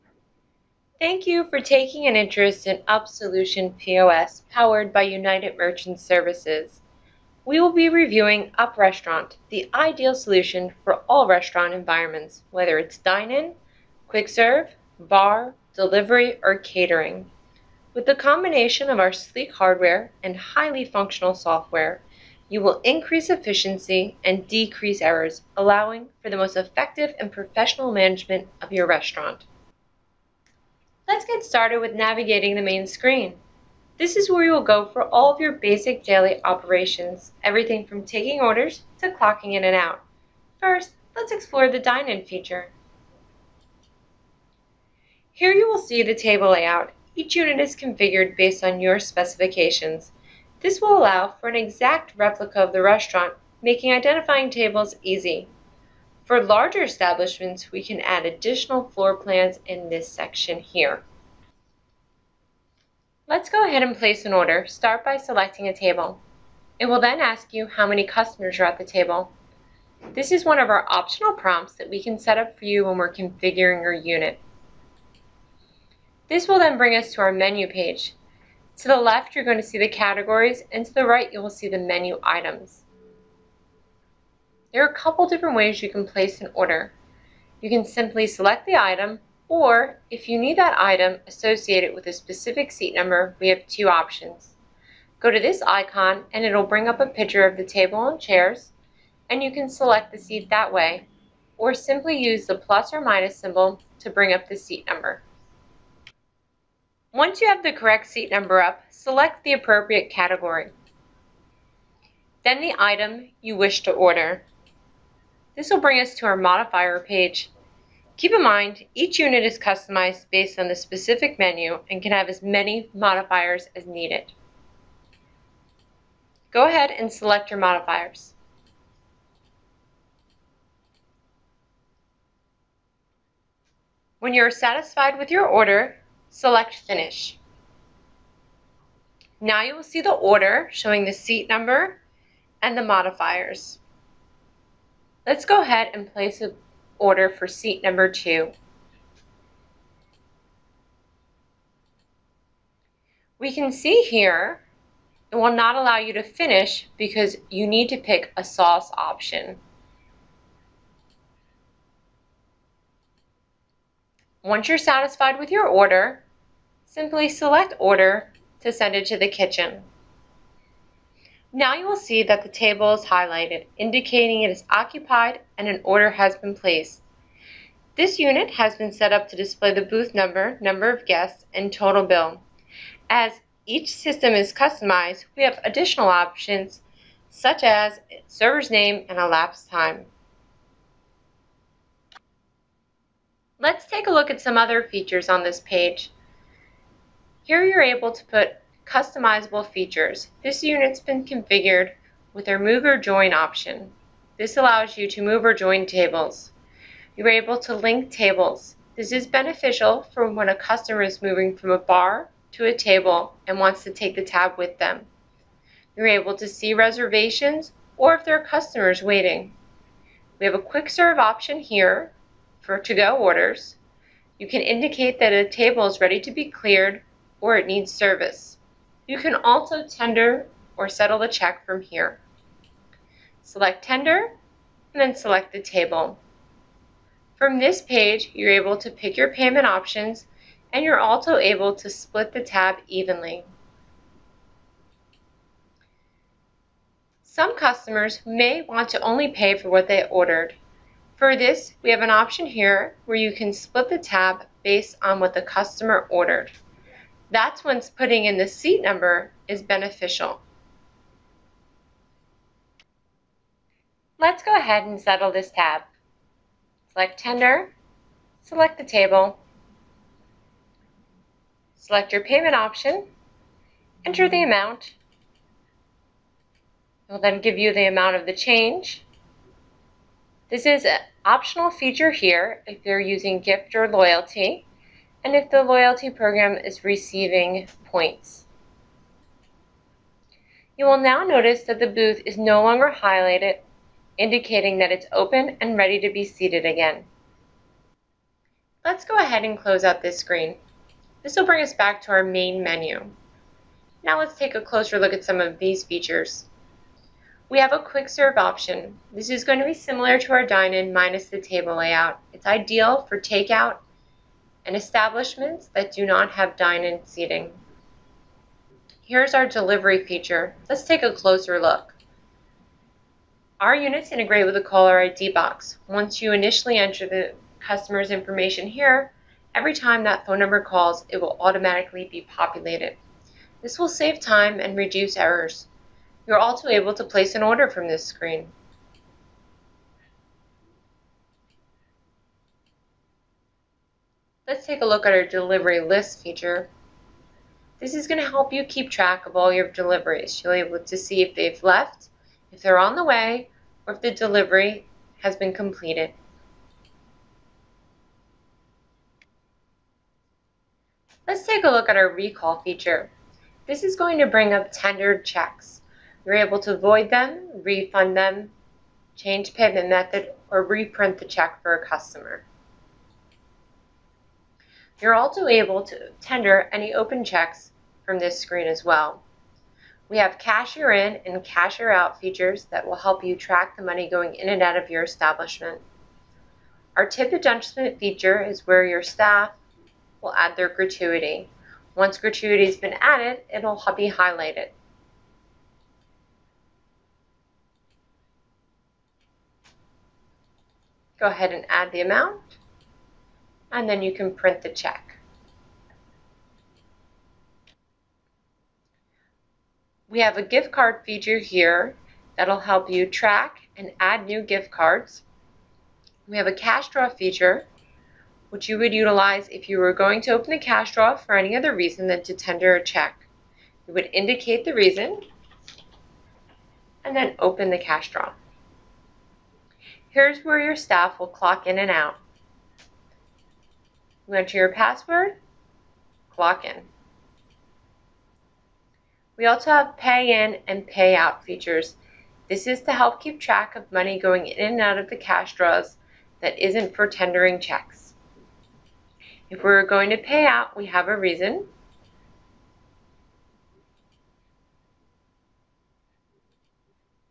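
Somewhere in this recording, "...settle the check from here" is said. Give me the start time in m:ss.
3:50.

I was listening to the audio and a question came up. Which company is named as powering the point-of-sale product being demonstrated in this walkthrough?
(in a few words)
United Merchant Services.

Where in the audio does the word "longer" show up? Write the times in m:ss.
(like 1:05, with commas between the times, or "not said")
4:52.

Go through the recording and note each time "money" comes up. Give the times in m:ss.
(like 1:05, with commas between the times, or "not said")
6:23, 7:23.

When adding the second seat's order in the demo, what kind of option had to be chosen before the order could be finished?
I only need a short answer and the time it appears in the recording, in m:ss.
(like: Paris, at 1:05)
sauce option, at 2:38.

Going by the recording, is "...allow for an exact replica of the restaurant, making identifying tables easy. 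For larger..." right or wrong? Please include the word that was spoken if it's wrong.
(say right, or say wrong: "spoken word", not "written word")
right.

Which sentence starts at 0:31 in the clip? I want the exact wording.
Let's get started with navigating the main screen.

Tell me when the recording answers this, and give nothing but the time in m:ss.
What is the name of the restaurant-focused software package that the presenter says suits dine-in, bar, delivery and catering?
0:08.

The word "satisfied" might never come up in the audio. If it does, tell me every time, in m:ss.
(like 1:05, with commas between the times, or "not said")
2:14, 2:44.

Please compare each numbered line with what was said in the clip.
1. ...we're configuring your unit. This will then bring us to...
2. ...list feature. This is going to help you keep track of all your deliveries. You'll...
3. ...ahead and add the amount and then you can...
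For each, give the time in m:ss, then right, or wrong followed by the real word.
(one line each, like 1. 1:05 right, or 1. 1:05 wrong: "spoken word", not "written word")
1. 1:12 right
2. 5:45 right
3. 6:41 right.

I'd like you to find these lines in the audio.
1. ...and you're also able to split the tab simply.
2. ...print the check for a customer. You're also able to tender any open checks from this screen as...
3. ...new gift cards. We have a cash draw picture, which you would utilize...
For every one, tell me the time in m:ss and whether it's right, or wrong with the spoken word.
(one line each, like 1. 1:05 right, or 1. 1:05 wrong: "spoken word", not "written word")
1. 4:00 wrong: "evenly", not "simply"
2. 6:10 wrong: "reprint", not "print"
3. 6:54 wrong: "feature", not "picture".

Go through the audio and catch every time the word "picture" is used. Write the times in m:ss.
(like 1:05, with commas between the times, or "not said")
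1:37.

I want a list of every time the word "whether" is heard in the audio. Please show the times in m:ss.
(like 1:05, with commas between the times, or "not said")
0:12.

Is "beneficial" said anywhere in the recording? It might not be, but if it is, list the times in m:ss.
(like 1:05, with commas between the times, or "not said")
3:29, 4:19.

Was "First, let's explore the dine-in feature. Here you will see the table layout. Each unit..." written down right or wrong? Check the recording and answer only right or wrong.
right.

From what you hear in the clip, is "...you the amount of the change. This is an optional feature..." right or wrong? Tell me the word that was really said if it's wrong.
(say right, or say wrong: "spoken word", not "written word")
right.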